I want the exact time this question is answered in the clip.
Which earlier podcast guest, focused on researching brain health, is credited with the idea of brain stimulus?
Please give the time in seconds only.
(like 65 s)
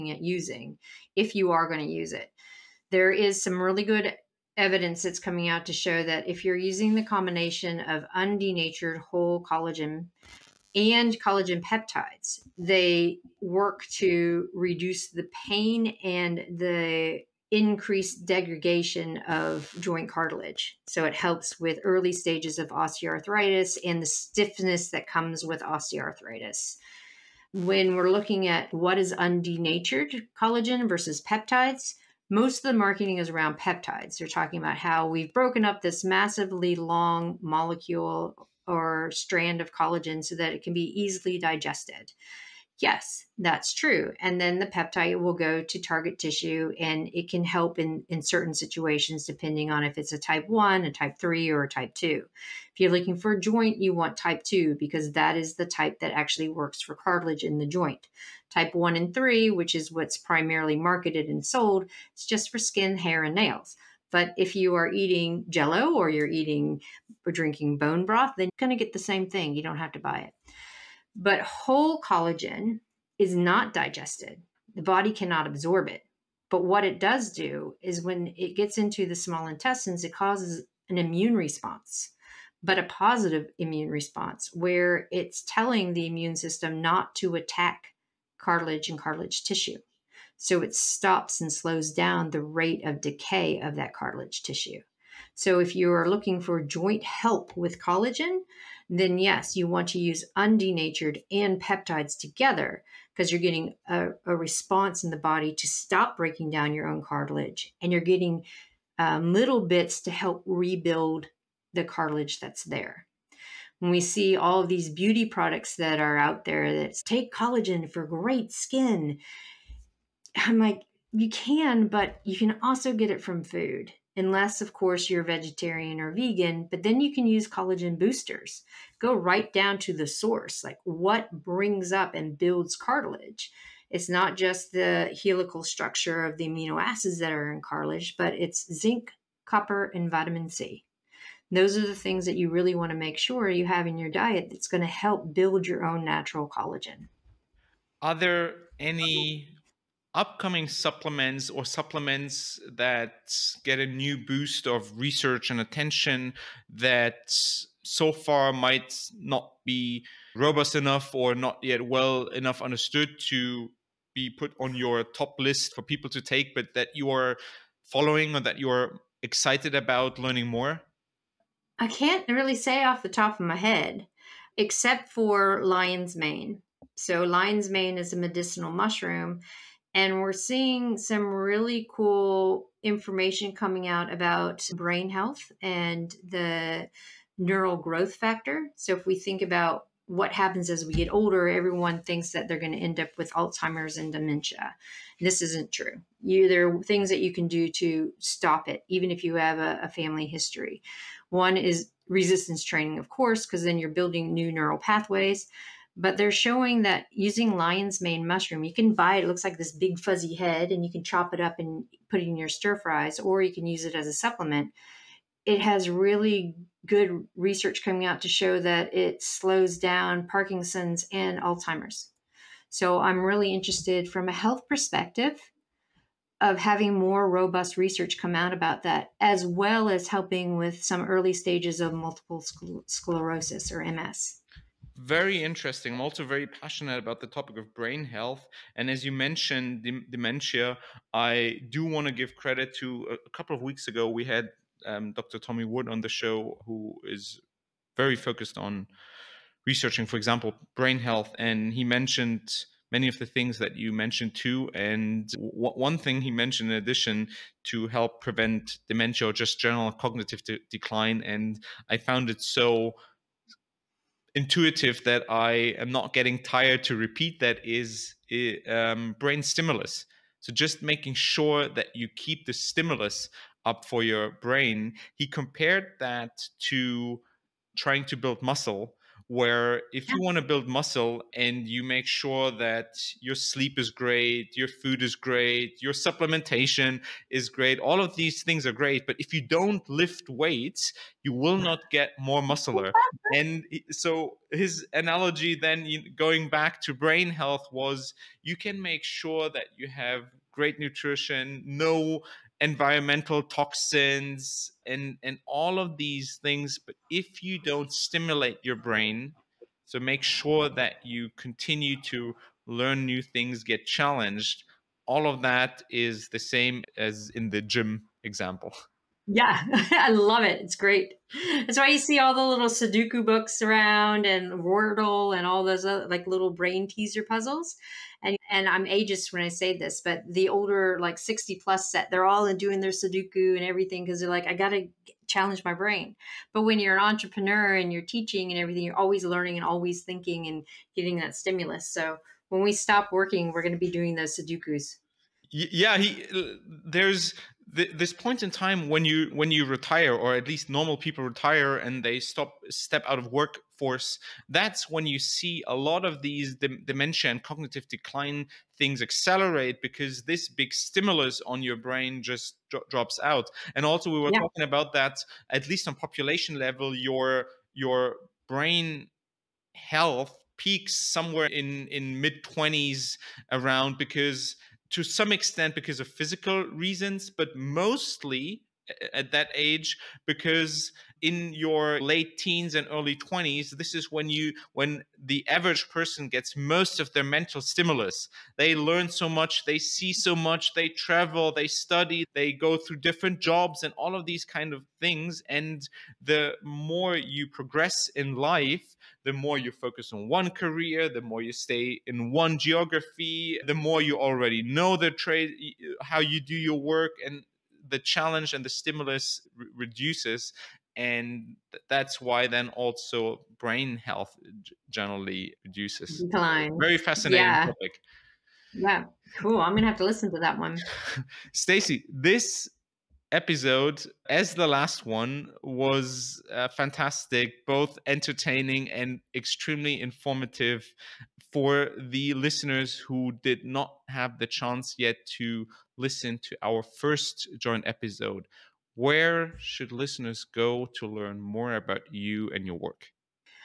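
245 s.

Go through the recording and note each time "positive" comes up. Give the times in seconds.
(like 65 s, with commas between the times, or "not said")
82 s.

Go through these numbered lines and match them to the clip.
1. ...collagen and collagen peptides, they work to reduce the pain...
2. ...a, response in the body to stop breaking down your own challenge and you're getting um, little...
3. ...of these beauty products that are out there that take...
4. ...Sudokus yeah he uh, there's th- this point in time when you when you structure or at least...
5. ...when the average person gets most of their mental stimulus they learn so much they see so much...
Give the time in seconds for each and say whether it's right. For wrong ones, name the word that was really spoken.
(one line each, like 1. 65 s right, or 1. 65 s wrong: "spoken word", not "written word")
1. 9 s right
2. 104 s wrong: "cartilage", not "challenge"
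3. 114 s right
4. 344 s wrong: "retire", not "structure"
5. 384 s right.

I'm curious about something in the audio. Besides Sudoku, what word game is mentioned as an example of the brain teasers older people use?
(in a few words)
Wordle.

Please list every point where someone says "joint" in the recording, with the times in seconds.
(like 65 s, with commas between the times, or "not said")
19 s, 53 s, 57 s, 96 s, 437 s.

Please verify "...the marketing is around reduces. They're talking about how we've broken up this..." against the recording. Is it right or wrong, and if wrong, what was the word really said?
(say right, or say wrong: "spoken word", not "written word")
wrong: "peptides", not "reduces".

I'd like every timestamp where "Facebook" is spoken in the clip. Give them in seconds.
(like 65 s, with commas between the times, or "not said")
not said.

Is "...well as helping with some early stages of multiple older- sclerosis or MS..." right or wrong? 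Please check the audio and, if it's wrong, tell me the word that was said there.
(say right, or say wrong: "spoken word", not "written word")
wrong: "scler", not "older".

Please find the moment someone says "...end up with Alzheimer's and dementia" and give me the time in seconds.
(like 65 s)
192 s.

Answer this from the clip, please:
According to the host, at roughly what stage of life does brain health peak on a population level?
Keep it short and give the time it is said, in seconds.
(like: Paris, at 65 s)
Mid 20s, at 372 s.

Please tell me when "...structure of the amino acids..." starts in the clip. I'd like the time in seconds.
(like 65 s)
135 s.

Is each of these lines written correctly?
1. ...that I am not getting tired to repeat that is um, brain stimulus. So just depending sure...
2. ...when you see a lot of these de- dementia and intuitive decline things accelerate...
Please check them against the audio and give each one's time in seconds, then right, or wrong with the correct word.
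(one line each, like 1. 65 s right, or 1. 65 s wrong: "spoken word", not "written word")
1. 265 s wrong: "making", not "depending"
2. 354 s wrong: "cognitive", not "intuitive".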